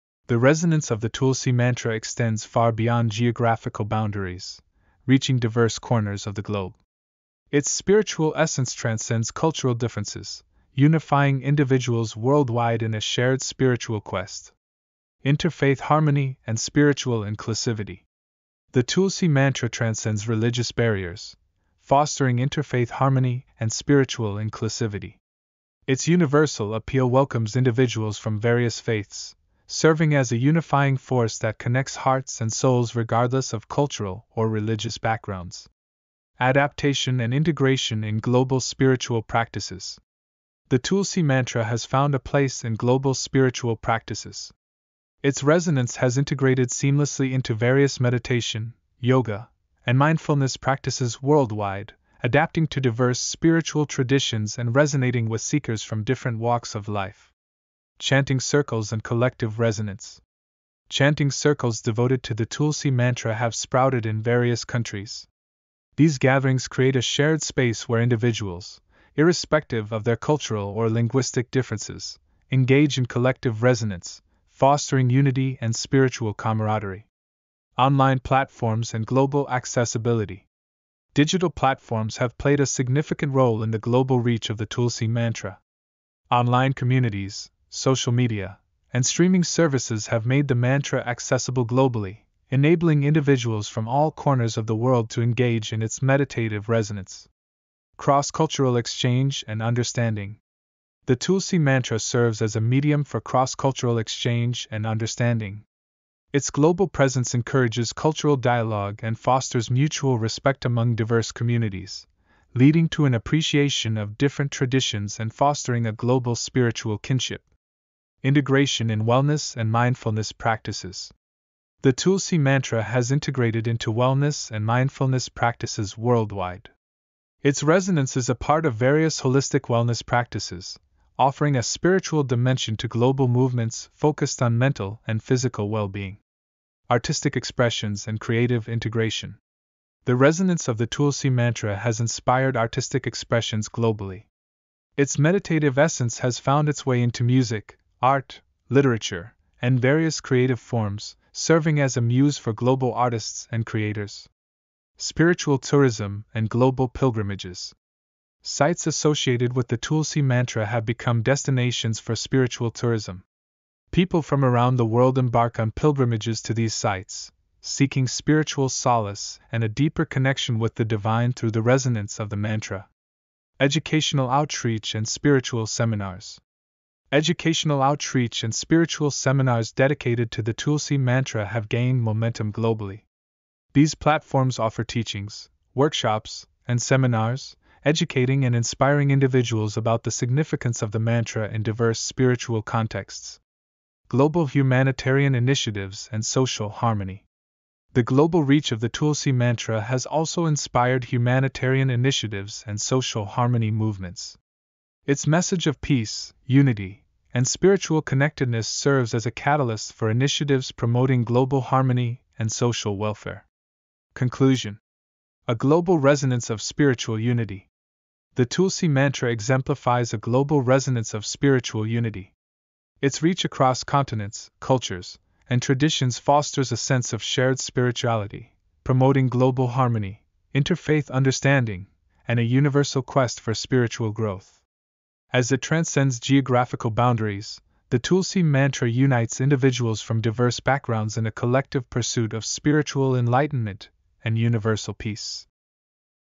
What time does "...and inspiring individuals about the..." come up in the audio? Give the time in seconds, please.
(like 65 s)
188 s.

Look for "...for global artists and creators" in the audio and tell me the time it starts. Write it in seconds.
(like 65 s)
152 s.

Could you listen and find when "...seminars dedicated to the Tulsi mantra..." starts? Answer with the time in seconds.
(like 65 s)
179 s.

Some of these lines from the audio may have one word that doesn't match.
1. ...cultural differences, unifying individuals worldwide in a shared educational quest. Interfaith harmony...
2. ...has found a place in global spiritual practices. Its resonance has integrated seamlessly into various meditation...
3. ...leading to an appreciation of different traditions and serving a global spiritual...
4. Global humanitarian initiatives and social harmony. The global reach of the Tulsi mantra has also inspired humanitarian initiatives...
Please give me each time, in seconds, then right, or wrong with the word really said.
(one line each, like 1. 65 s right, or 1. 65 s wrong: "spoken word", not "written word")
1. 9 s wrong: "spiritual", not "educational"
2. 41 s right
3. 112 s wrong: "fostering", not "serving"
4. 194 s right.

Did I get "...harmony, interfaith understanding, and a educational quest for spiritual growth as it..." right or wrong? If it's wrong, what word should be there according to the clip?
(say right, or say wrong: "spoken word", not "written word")
wrong: "universal", not "educational".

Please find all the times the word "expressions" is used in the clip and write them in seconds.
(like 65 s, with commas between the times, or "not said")
137 s, 143 s.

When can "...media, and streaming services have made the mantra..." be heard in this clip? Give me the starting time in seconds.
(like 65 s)
88 s.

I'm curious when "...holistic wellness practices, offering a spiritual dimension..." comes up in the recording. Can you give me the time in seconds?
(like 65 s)
129 s.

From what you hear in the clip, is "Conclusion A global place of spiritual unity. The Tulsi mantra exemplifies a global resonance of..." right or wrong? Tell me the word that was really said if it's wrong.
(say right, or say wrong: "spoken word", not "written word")
wrong: "resonance", not "place".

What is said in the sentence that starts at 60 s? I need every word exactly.
Chanting circles devoted to the Tulsi mantra have sprouted in various countries.